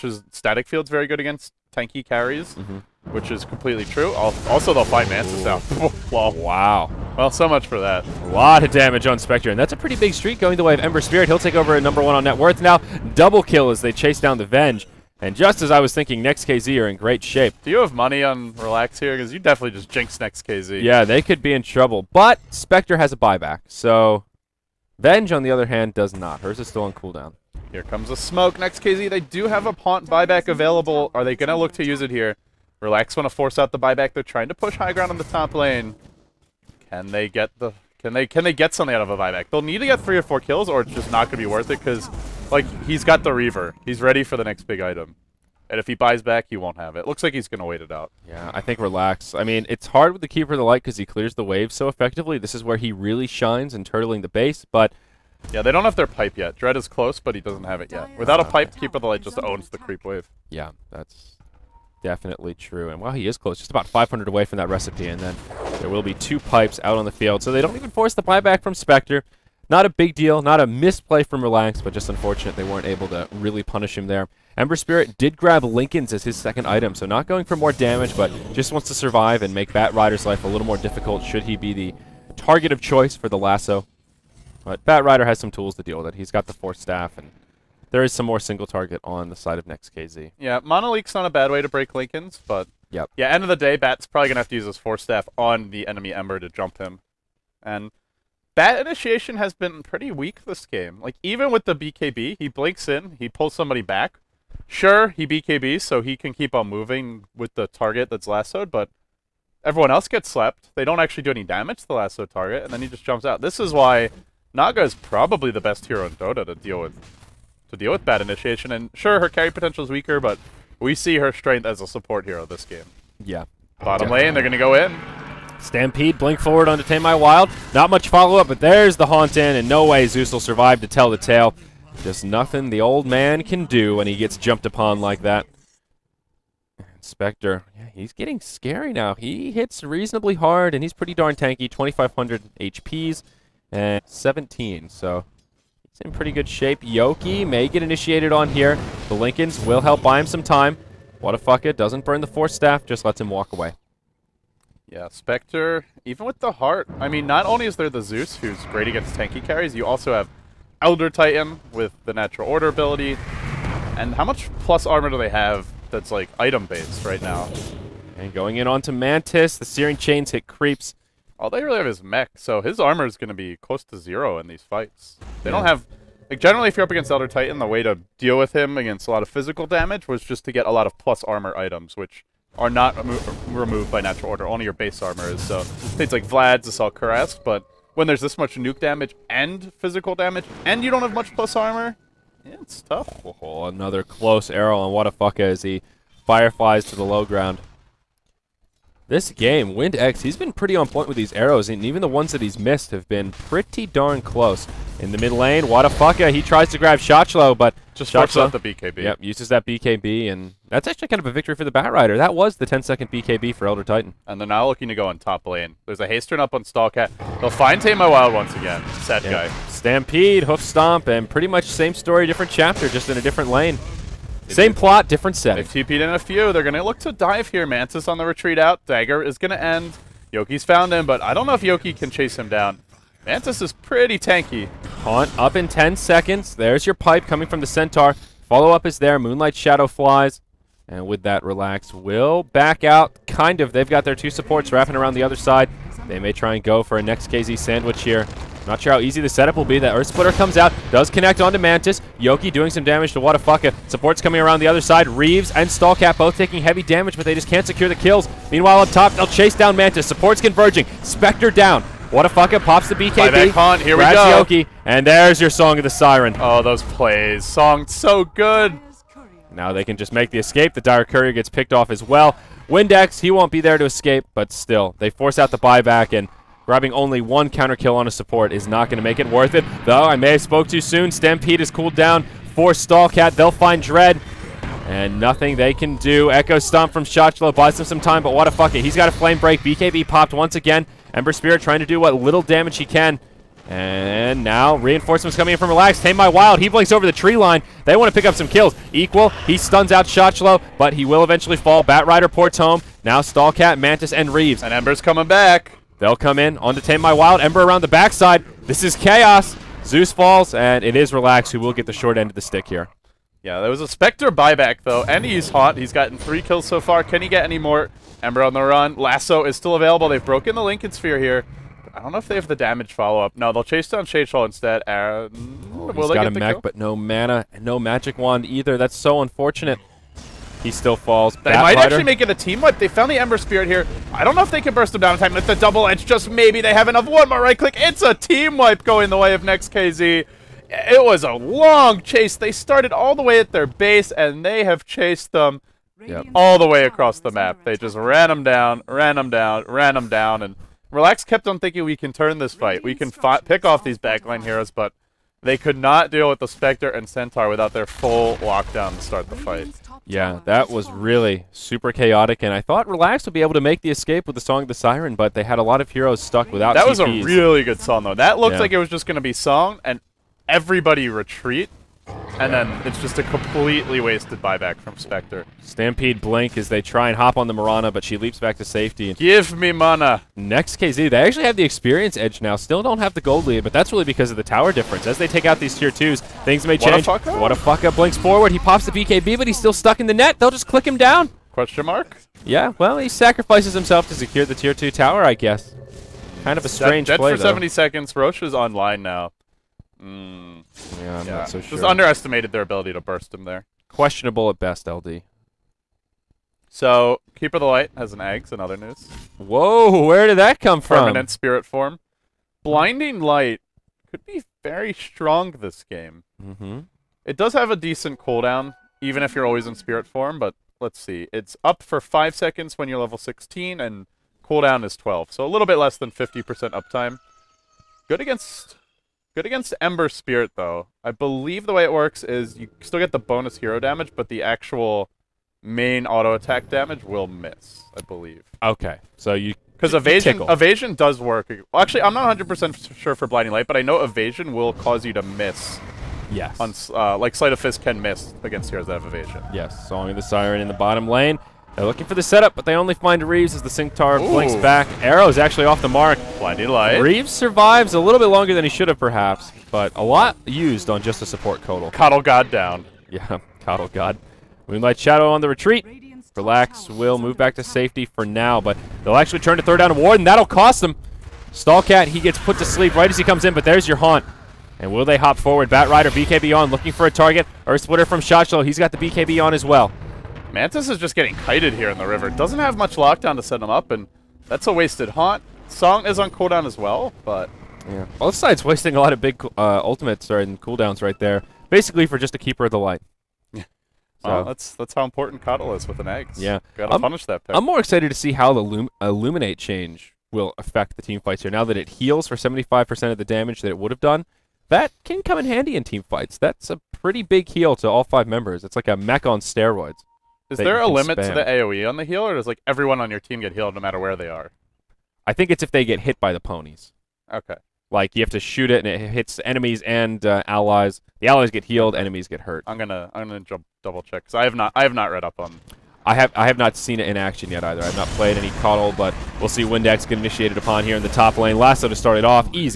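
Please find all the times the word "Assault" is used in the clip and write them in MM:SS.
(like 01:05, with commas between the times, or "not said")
03:06.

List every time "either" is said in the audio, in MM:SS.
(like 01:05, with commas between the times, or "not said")
05:28, 08:47.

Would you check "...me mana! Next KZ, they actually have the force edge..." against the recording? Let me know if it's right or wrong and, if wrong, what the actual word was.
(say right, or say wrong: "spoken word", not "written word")
wrong: "experience", not "force".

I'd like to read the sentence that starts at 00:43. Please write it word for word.
He's ready for the next big item.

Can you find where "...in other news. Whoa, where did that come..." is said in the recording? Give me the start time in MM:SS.
06:48.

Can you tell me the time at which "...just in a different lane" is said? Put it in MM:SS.
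03:42.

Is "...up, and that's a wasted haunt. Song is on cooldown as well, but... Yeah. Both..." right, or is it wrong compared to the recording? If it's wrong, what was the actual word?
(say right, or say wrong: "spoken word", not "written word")
right.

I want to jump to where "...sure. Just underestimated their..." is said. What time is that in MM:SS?
06:41.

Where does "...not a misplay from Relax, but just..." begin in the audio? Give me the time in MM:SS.
01:10.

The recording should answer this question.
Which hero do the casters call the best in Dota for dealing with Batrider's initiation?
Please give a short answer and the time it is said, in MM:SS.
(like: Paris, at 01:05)
Naga, at 01:54.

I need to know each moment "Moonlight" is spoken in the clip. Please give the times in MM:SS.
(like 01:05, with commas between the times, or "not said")
03:59, 07:44.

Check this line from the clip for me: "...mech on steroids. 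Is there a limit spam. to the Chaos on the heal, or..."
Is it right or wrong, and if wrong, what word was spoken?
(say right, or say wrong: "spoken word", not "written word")
wrong: "AoE", not "Chaos".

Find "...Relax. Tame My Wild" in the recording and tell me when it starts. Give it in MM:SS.
04:55.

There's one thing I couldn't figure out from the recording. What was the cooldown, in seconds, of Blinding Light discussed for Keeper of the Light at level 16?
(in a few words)
12.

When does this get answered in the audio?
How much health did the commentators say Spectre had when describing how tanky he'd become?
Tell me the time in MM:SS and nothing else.
02:21.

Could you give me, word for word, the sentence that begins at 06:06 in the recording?
was a really good song, though.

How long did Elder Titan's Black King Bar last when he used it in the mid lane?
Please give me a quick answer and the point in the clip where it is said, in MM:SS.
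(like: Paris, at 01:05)
10 seconds, at 03:32.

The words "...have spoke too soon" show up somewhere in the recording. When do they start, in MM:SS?
04:40.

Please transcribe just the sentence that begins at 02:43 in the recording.
And how much plus armor do they have that's, like, item-based right now?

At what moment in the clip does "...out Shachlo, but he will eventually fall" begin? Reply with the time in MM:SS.
04:59.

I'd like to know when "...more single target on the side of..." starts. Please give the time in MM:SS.
01:28.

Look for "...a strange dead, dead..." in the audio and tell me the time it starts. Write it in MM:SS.
06:36.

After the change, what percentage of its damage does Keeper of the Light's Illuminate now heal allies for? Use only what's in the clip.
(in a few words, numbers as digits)
75%.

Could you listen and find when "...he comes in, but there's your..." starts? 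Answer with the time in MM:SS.
07:53.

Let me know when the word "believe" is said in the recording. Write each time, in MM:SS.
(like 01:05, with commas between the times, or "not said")
07:11, 07:18.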